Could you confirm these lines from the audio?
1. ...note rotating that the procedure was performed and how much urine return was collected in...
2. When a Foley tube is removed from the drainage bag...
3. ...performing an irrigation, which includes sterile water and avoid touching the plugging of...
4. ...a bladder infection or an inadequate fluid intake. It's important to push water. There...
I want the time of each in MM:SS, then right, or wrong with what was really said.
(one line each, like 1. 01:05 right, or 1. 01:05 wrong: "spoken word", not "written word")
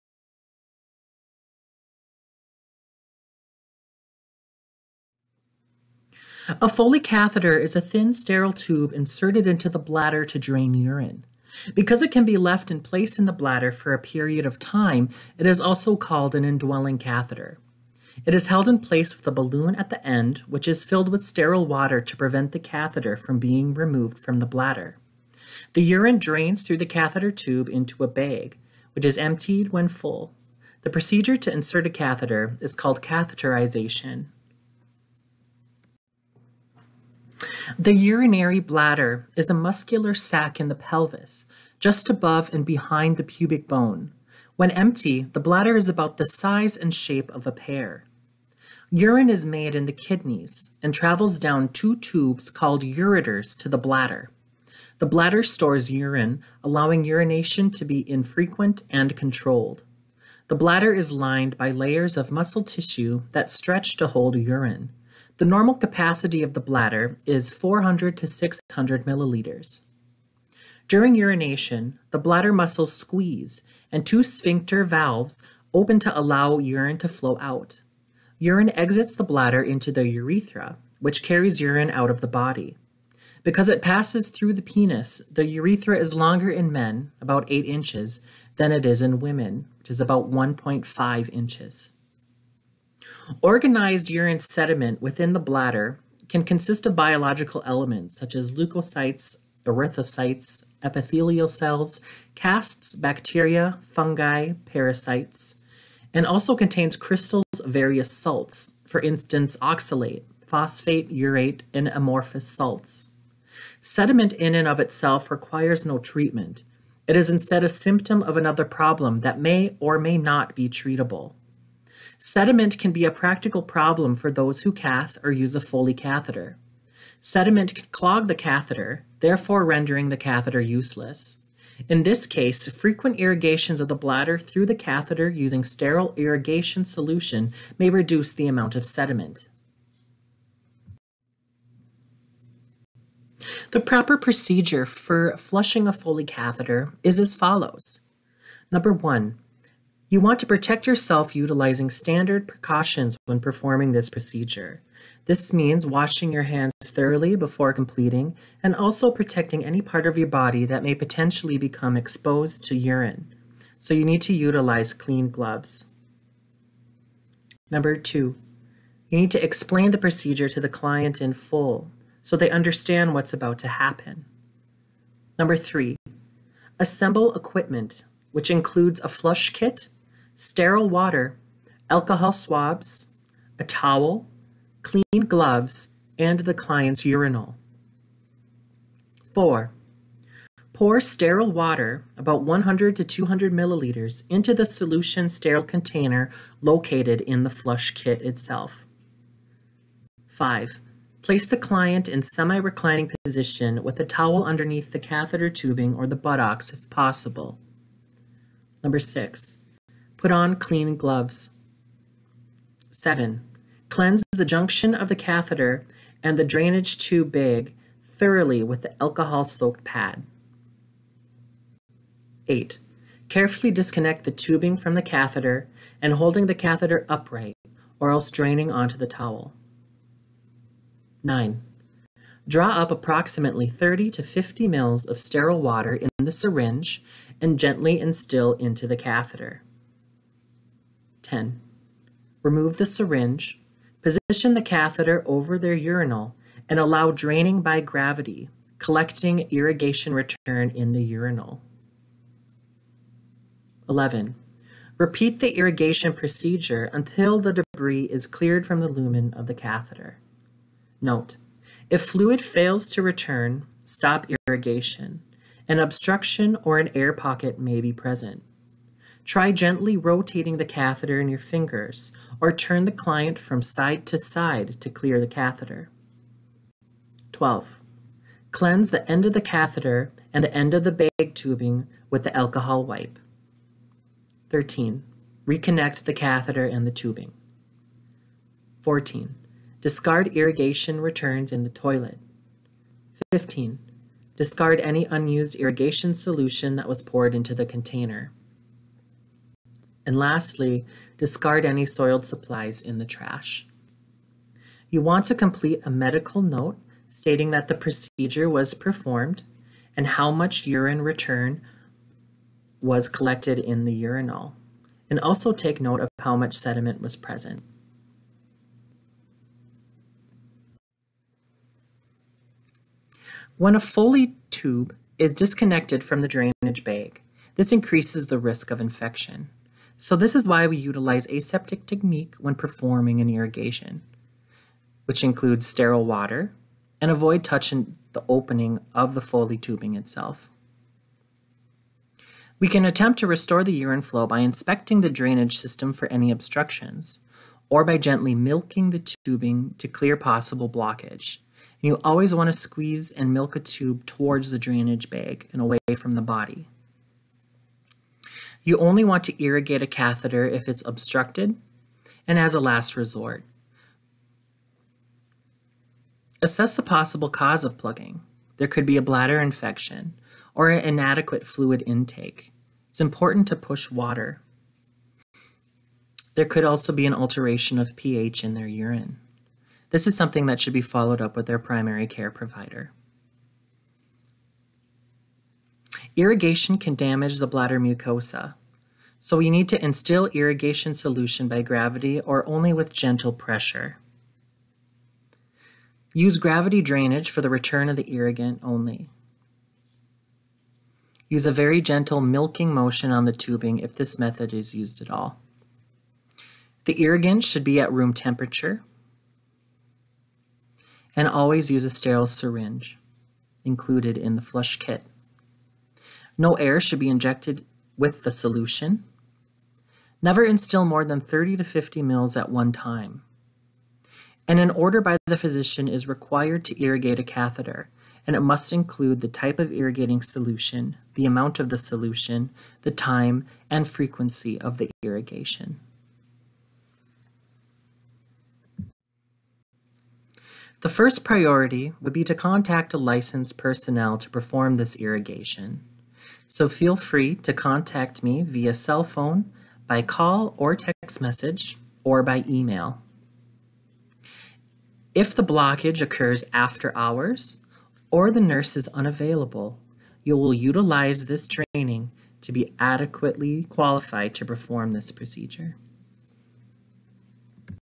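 1. 05:06 wrong: "stating", not "rotating"
2. 05:23 wrong: "disconnected", not "removed"
3. 05:32 wrong: "opening", not "plugging"
4. 06:08 right.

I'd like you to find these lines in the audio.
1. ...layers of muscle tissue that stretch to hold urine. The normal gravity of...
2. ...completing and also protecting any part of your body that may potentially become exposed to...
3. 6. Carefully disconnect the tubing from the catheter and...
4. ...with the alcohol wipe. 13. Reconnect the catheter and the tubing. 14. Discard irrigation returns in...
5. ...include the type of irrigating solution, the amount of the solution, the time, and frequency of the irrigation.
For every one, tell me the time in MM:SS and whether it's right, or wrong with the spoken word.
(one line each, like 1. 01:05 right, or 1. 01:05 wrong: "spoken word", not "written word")
1. 01:01 wrong: "capacity", not "gravity"
2. 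02:37 right
3. 03:42 wrong: "8", not "6"
4. 04:42 right
5. 07:08 right.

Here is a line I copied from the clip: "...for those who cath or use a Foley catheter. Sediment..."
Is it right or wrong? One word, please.
right.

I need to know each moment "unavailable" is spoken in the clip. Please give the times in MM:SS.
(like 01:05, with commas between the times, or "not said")
07:38.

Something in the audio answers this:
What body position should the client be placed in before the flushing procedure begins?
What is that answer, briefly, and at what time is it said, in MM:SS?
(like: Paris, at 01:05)
semi-reclining, at 03:22.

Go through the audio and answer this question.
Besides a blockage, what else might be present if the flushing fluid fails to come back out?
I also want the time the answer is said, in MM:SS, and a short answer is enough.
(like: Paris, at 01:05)
air pocket, at 04:26.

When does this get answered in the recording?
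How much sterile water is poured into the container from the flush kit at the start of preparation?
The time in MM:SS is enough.
03:12.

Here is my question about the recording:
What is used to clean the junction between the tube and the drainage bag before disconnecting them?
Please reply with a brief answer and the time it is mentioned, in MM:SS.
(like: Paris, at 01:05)
alcohol-soaked pad, at 03:39.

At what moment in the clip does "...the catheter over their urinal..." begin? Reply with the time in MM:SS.
04:04.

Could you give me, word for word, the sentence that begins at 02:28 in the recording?
Number one, you want to protect yourself utilizing standard precautions when performing this procedure.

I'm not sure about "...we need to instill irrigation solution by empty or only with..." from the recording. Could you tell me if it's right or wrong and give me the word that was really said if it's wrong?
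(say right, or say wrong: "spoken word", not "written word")
wrong: "gravity", not "empty".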